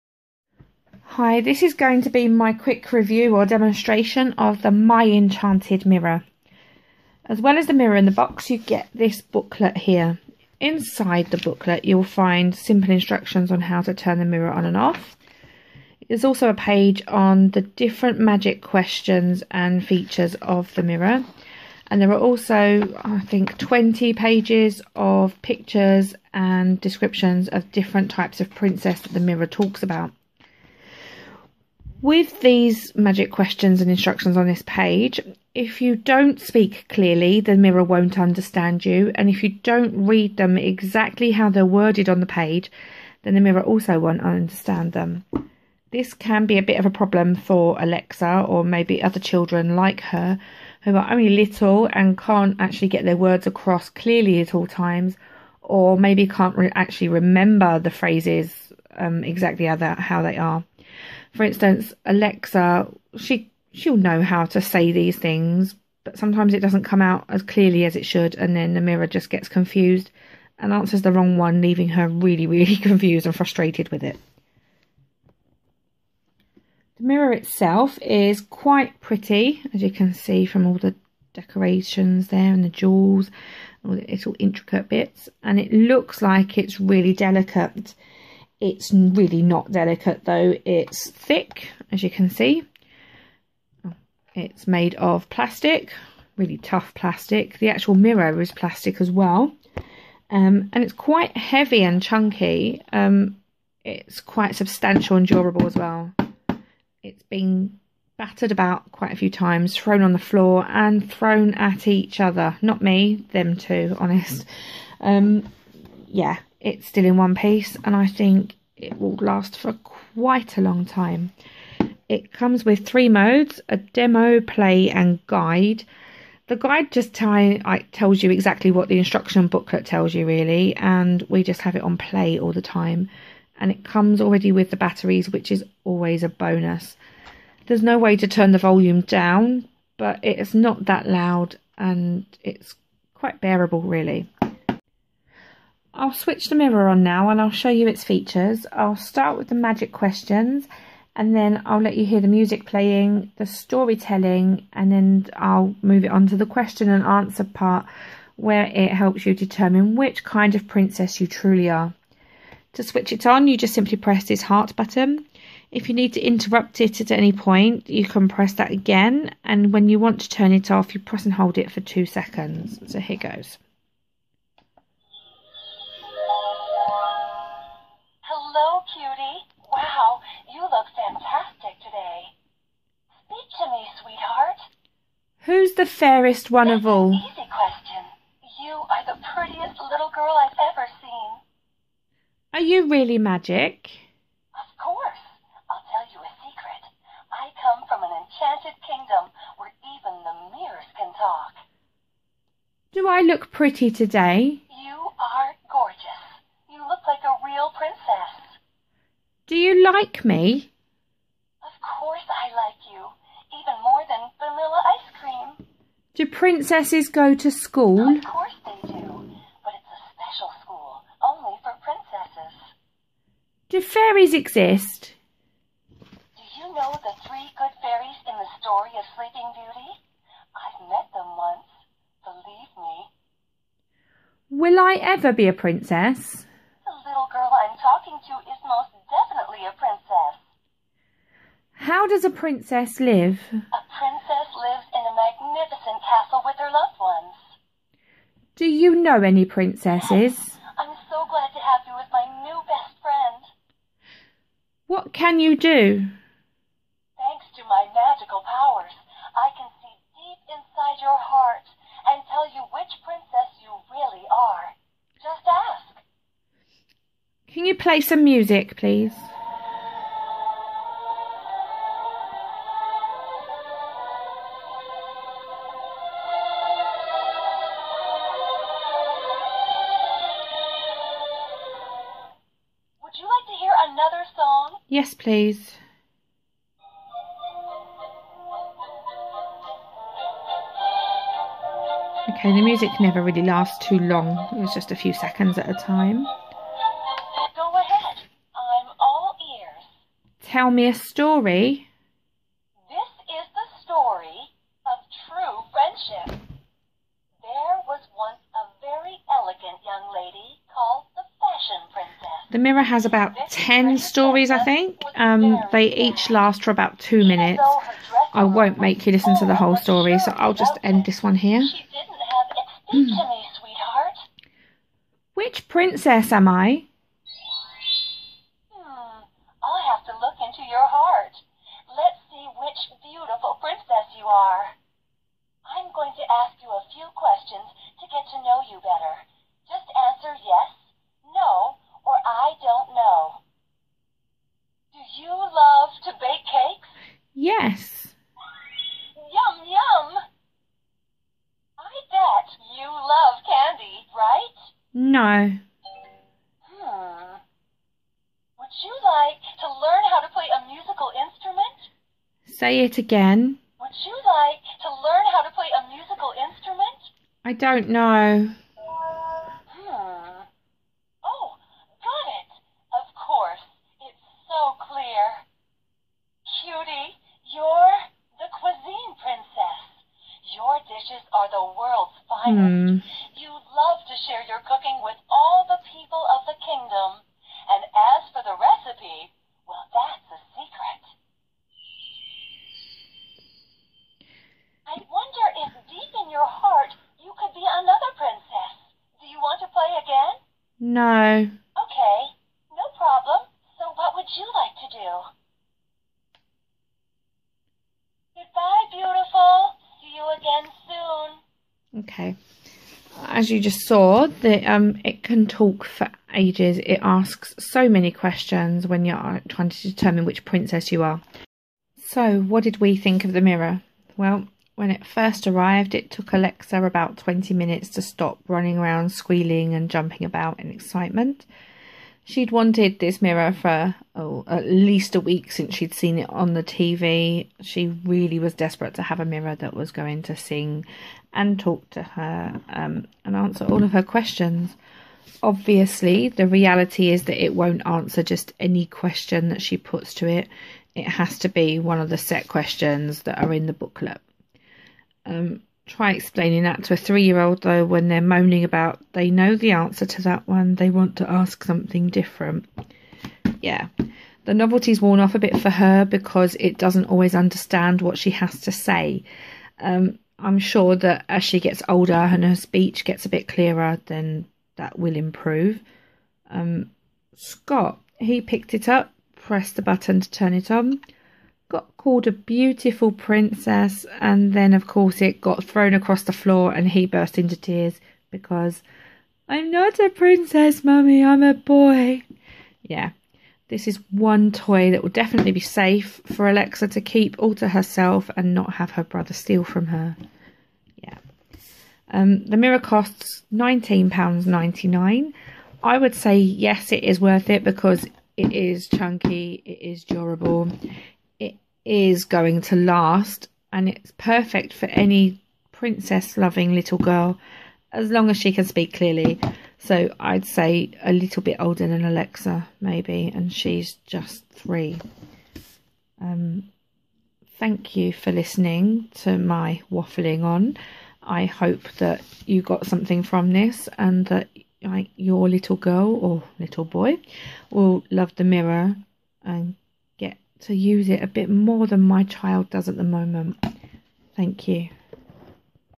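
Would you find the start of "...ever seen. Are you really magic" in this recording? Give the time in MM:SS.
03:10.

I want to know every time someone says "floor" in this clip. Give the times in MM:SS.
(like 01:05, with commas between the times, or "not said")
01:50, 08:06.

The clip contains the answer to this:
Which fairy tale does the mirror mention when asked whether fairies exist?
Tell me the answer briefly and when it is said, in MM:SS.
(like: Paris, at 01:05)
Sleeping Beauty, at 03:49.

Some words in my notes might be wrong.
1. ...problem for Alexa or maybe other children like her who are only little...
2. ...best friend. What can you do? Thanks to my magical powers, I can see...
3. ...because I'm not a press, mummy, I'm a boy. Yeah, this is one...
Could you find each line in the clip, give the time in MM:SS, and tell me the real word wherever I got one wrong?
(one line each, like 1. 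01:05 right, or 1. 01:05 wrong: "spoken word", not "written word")
1. 00:46 right
2. 04:12 right
3. 08:08 wrong: "princess", not "press".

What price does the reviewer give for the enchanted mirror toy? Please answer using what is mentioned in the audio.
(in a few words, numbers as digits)
£19.99.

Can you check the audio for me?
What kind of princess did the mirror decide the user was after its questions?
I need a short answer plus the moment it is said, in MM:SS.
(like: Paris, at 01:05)
cuisine princess, at 06:18.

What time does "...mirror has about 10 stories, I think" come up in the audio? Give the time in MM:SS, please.
05:12.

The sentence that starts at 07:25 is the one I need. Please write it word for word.
Obviously, the reality is that it won't answer just any question that she puts to it.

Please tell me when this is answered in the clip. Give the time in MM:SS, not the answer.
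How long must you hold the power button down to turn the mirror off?
02:51.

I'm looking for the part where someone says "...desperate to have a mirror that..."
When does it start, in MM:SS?
07:18.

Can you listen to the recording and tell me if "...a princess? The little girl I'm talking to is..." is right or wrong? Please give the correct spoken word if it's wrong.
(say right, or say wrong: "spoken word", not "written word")
right.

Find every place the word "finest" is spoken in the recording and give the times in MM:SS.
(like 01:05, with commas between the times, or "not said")
06:22.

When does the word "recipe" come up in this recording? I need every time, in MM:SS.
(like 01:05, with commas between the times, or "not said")
06:28.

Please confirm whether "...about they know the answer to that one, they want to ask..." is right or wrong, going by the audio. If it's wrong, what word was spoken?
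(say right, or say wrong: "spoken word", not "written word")
right.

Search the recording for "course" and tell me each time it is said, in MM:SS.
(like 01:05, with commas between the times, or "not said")
03:14, 03:31, 03:38, 06:13, 08:04.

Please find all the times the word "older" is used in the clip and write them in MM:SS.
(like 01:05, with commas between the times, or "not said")
07:51, 08:41.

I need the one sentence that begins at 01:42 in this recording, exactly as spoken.
Um, it's quite substantial and durable as well.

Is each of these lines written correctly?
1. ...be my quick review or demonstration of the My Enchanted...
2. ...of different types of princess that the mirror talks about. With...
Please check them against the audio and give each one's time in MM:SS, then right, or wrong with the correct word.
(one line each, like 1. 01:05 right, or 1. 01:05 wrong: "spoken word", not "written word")
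1. 00:02 right
2. 00:27 right.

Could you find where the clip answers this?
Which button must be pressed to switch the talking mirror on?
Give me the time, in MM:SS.
02:44.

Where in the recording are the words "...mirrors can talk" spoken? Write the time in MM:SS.
03:20.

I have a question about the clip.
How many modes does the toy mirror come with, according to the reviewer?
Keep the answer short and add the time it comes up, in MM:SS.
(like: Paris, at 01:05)
3, at 02:02.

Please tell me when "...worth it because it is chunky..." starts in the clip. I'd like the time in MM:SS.
08:27.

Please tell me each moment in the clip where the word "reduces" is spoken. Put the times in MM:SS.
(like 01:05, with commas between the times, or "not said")
not said.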